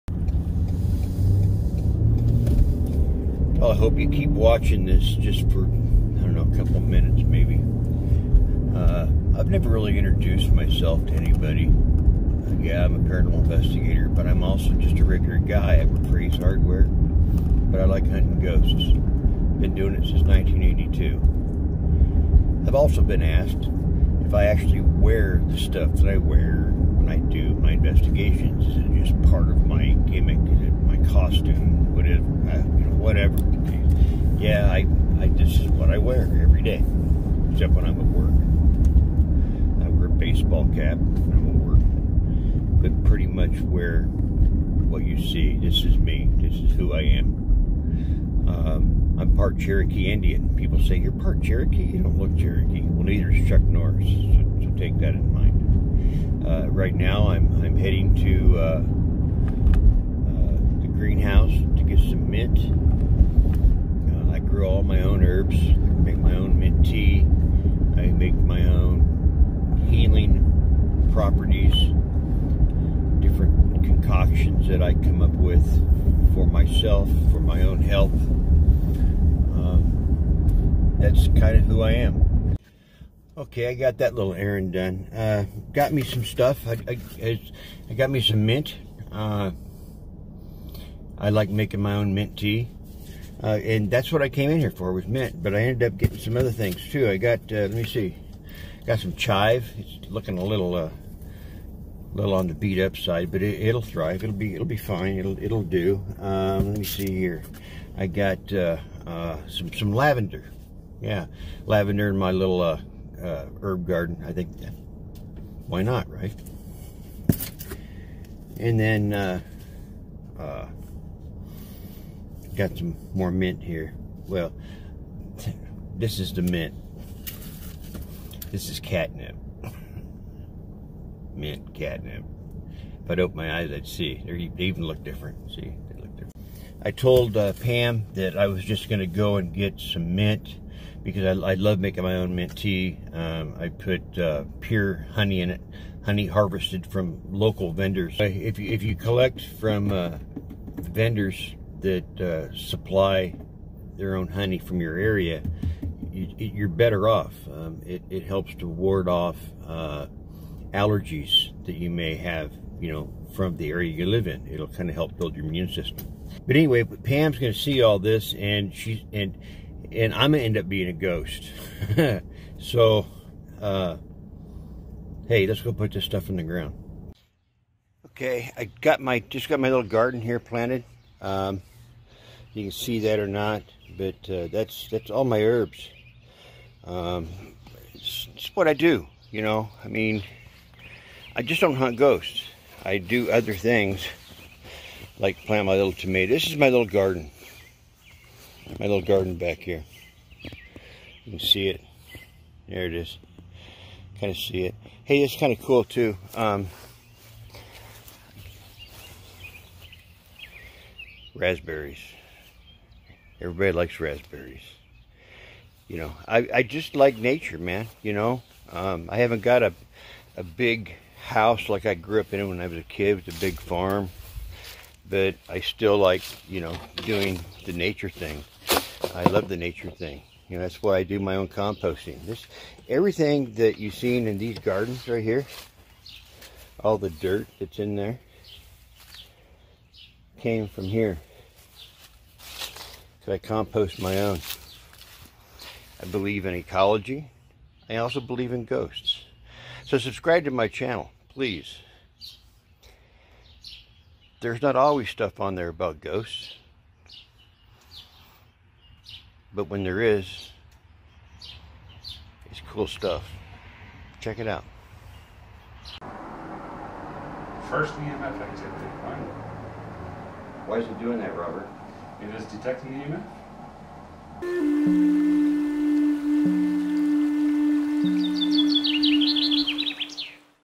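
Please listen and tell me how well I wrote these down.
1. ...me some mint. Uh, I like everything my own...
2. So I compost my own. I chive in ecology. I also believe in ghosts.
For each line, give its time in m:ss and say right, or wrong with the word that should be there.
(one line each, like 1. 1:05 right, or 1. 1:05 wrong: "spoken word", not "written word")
1. 1:28 wrong: "making", not "everything"
2. 4:03 wrong: "believe", not "chive".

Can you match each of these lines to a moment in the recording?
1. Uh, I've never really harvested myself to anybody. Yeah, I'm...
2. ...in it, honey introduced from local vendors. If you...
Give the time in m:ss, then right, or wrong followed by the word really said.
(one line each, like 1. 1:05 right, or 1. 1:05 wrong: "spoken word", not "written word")
1. 0:08 wrong: "introduced", not "harvested"
2. 2:25 wrong: "harvested", not "introduced".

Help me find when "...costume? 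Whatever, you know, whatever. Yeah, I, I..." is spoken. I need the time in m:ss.
0:31.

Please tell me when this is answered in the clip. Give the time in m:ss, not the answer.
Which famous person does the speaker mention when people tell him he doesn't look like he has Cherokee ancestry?
0:53.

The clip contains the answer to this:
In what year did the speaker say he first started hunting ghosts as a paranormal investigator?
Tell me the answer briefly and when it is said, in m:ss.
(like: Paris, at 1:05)
1982, at 0:20.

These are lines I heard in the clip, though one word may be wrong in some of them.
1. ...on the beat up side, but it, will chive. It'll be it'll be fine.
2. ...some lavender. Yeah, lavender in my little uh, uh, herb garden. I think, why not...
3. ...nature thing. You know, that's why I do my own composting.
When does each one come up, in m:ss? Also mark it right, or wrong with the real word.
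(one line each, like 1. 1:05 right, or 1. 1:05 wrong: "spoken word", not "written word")
1. 1:42 wrong: "thrive", not "chive"
2. 1:49 right
3. 3:49 right.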